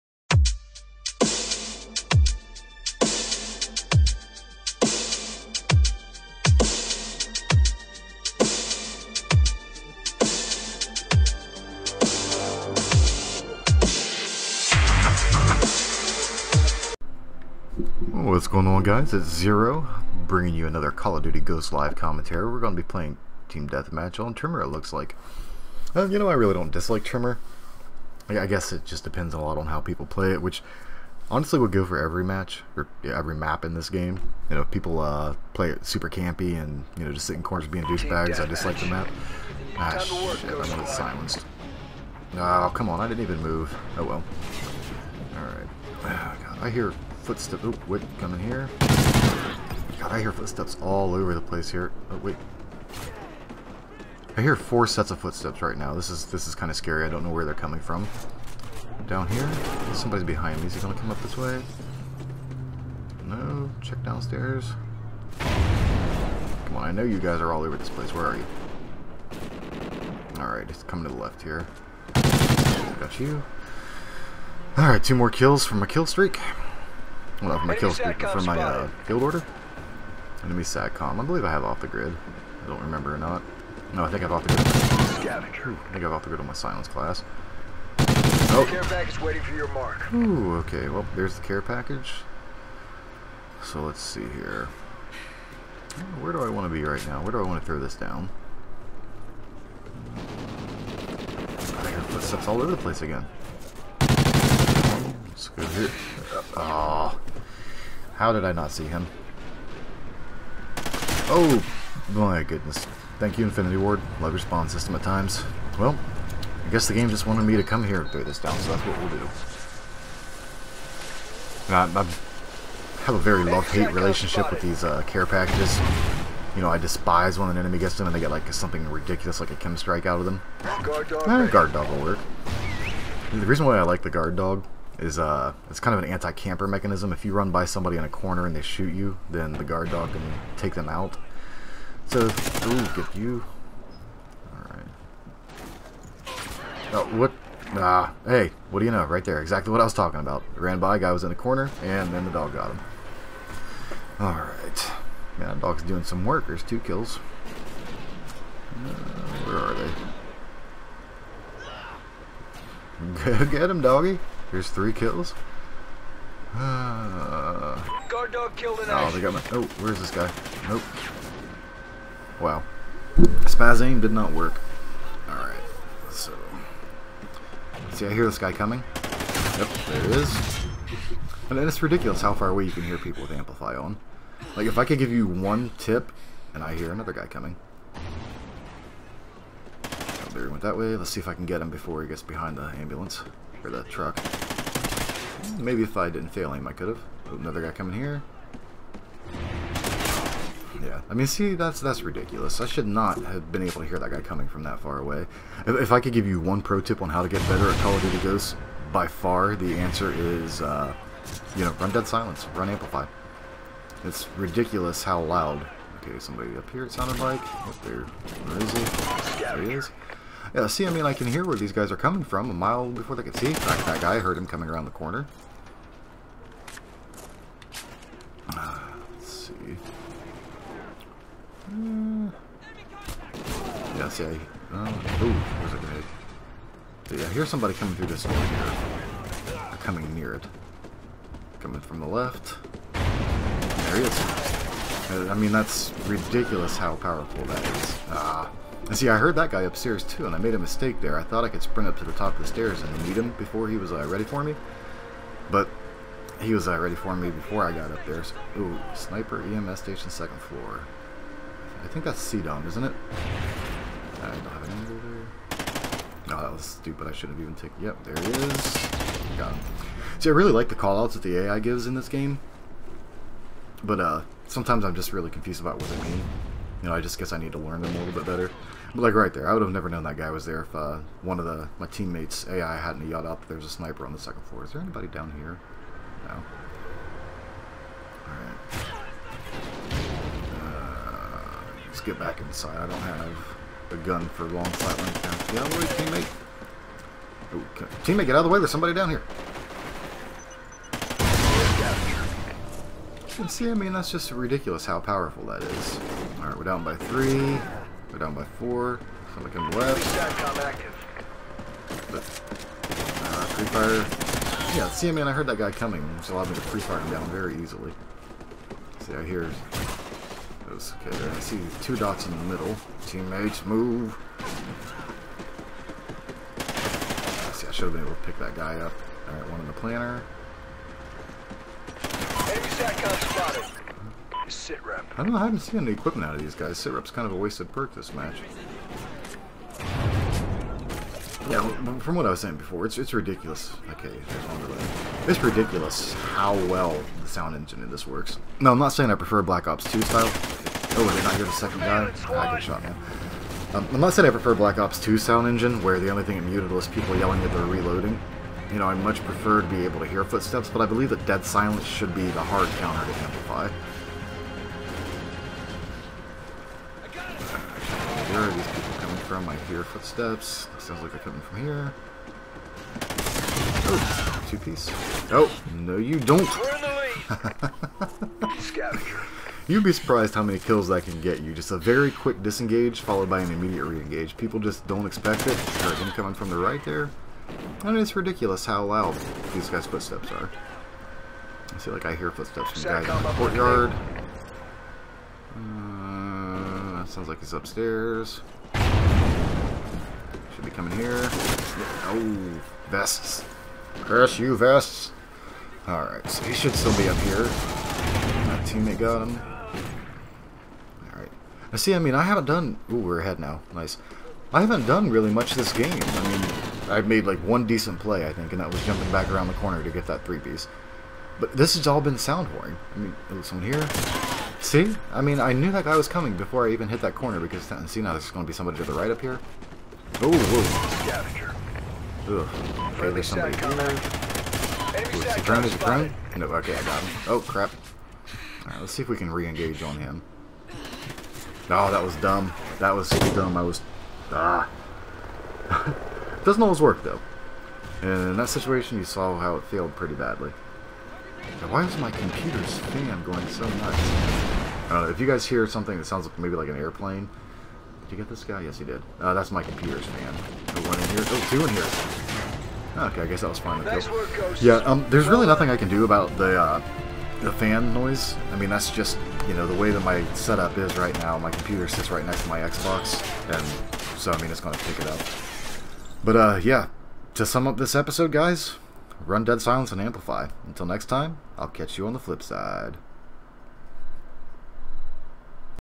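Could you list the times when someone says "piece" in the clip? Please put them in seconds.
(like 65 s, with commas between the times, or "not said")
374 s, 420 s.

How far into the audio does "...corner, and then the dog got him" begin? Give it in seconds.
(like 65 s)
151 s.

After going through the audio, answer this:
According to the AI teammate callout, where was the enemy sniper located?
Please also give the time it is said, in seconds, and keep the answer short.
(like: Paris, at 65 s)
EMS station second floor, at 259 s.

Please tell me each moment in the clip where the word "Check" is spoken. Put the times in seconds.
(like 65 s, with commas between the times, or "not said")
63 s.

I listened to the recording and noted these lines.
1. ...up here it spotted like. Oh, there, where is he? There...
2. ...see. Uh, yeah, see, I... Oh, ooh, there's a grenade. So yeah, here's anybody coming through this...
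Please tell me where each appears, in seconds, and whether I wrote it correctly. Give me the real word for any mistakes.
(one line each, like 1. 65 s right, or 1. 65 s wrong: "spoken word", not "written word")
1. 216 s wrong: "sounded", not "spotted"
2. 229 s wrong: "somebody", not "anybody".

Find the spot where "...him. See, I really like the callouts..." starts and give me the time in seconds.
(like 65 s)
269 s.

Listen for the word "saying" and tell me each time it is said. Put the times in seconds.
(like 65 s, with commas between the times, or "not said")
342 s, 348 s, 354 s.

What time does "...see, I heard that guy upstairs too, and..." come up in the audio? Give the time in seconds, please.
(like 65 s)
248 s.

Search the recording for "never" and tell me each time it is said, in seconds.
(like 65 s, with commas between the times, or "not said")
279 s.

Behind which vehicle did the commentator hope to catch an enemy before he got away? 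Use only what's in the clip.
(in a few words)
Ambulance.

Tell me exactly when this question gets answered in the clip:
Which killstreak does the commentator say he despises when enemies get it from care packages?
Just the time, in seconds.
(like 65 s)
129 s.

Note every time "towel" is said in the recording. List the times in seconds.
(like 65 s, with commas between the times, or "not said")
not said.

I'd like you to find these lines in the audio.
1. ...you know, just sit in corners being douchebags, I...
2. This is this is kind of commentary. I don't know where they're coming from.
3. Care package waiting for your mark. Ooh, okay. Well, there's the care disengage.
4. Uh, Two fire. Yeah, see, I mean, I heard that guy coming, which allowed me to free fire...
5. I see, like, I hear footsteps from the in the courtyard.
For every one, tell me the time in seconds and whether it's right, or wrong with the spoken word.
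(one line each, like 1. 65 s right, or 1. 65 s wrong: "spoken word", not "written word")
1. 36 s right
2. 55 s wrong: "scary", not "commentary"
3. 88 s wrong: "package", not "disengage"
4. 312 s wrong: "Three", not "Two"
5. 391 s right.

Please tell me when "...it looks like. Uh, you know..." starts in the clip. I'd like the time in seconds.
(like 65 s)
24 s.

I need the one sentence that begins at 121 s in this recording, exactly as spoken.
I, I, have a very love-hate relationship with these uh, care packages.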